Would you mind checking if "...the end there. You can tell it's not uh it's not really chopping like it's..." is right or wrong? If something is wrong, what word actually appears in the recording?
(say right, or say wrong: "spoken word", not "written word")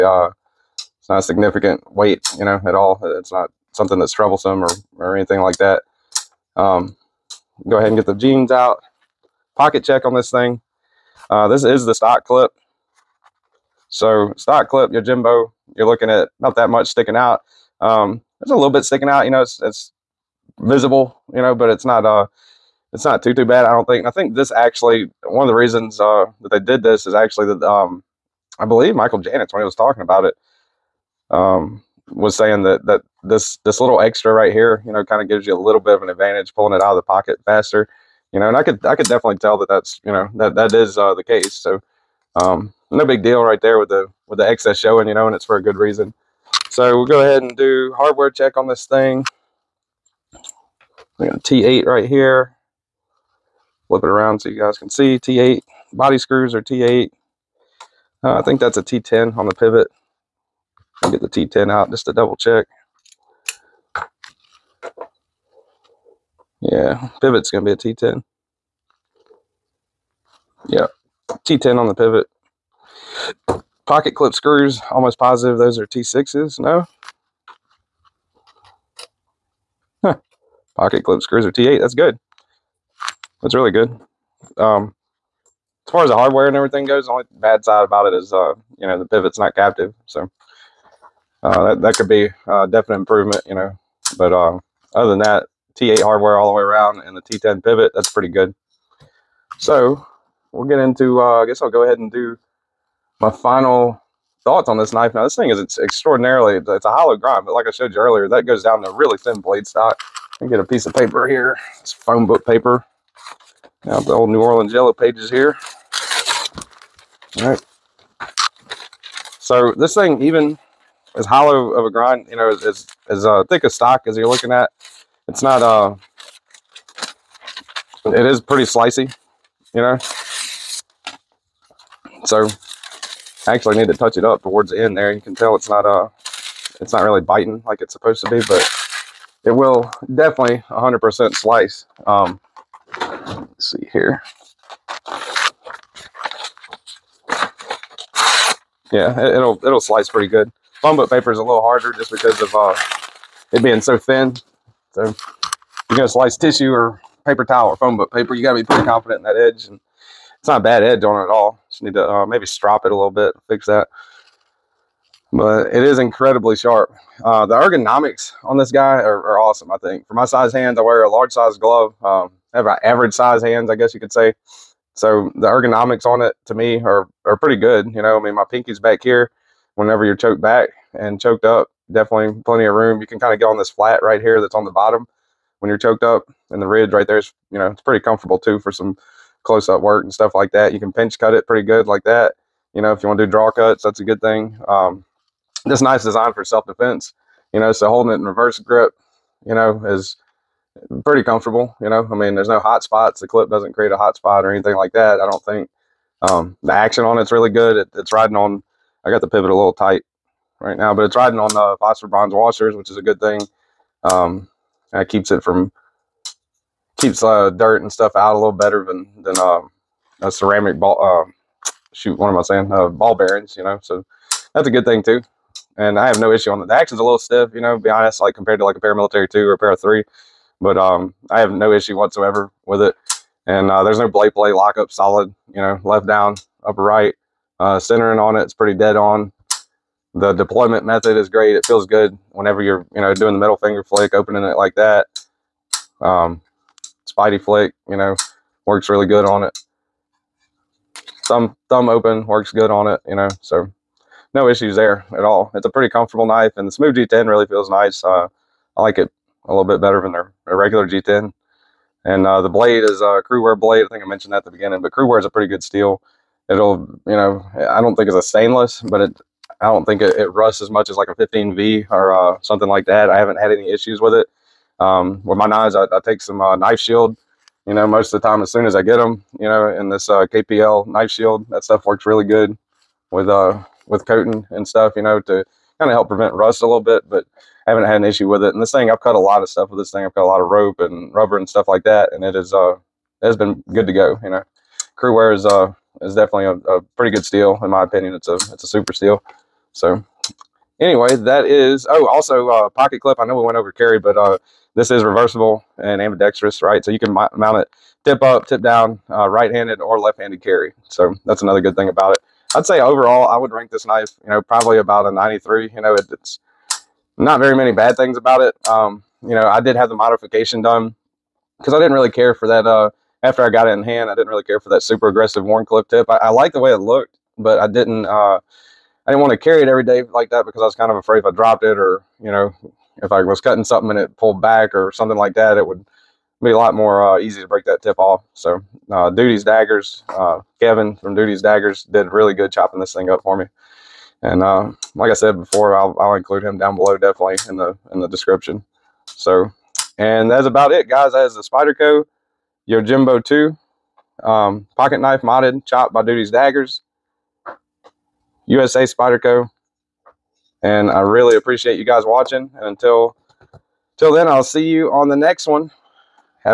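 wrong: "biting", not "chopping".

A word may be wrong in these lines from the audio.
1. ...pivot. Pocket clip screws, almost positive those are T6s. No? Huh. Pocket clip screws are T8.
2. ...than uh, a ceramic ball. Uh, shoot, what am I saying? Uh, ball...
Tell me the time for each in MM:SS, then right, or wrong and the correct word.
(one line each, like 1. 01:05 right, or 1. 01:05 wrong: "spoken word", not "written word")
1. 01:11 right
2. 03:39 right.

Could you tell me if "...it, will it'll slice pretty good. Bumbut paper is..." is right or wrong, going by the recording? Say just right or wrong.
right.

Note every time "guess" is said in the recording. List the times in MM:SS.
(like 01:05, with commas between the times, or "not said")
01:41, 02:53.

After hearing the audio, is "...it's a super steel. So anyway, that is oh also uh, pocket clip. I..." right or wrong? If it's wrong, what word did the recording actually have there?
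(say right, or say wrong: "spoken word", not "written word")
right.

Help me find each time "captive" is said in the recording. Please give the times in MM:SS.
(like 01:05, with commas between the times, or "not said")
01:29.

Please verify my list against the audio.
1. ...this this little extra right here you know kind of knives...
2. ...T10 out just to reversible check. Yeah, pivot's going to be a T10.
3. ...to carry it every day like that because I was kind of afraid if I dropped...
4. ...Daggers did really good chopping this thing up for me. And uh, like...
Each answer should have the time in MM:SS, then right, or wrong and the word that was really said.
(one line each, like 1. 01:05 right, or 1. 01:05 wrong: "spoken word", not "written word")
1. 00:33 wrong: "gives", not "knives"
2. 01:01 wrong: "double", not "reversible"
3. 05:29 right
4. 05:41 right.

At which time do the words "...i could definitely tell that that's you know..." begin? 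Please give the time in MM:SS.
00:38.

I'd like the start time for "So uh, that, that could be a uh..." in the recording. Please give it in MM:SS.
01:30.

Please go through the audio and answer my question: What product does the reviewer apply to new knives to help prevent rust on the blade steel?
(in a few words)
KPL knife shield.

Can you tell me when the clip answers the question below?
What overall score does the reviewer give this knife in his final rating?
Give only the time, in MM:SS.
05:14.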